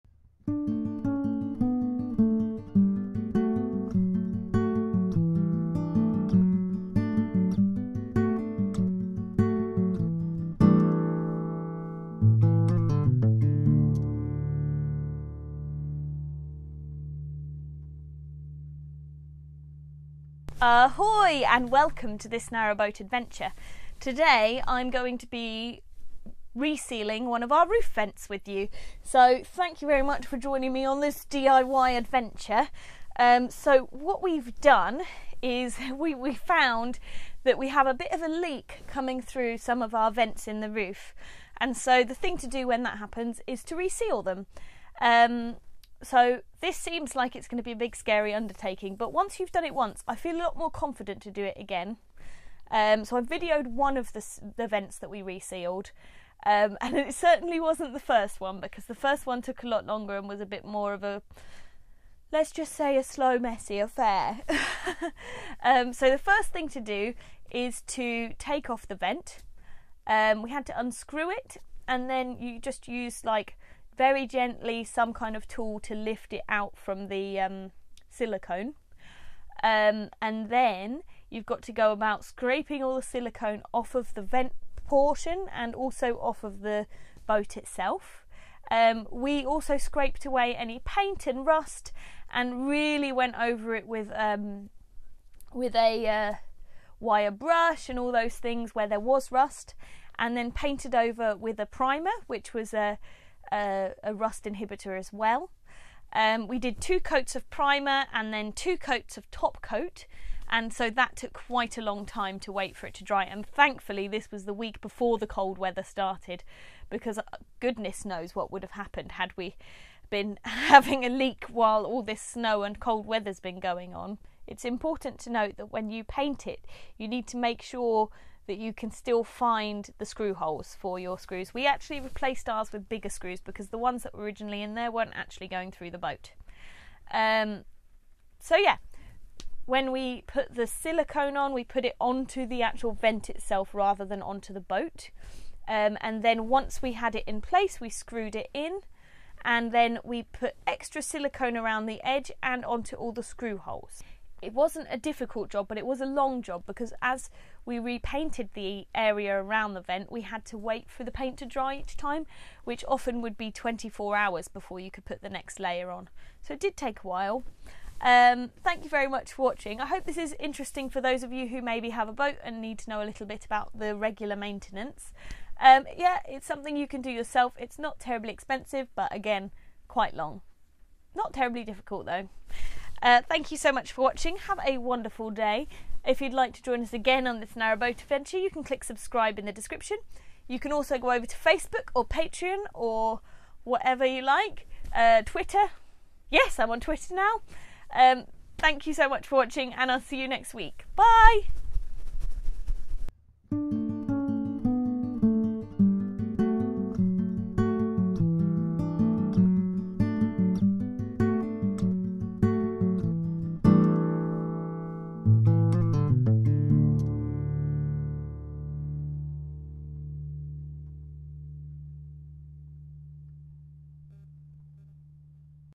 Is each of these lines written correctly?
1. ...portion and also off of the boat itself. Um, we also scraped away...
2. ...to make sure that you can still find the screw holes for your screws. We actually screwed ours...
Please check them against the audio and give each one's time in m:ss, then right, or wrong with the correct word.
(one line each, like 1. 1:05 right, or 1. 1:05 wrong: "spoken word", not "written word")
1. 1:24 right
2. 2:07 wrong: "replaced", not "screwed".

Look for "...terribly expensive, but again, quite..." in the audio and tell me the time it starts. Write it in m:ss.
2:57.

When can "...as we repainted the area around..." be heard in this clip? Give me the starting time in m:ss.
2:37.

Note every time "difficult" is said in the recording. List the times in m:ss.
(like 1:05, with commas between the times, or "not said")
2:34, 3:01.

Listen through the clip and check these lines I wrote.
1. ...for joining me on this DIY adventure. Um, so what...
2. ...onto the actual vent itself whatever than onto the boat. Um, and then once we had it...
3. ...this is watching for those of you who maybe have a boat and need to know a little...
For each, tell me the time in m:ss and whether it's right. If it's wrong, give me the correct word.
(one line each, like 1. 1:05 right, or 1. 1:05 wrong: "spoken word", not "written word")
1. 0:30 right
2. 2:21 wrong: "rather", not "whatever"
3. 2:50 wrong: "interesting", not "watching".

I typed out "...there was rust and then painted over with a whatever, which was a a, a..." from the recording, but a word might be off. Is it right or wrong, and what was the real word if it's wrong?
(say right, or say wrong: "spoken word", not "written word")
wrong: "primer", not "whatever".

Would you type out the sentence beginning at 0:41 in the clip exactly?
And so the thing to do when that happens is to reseal them.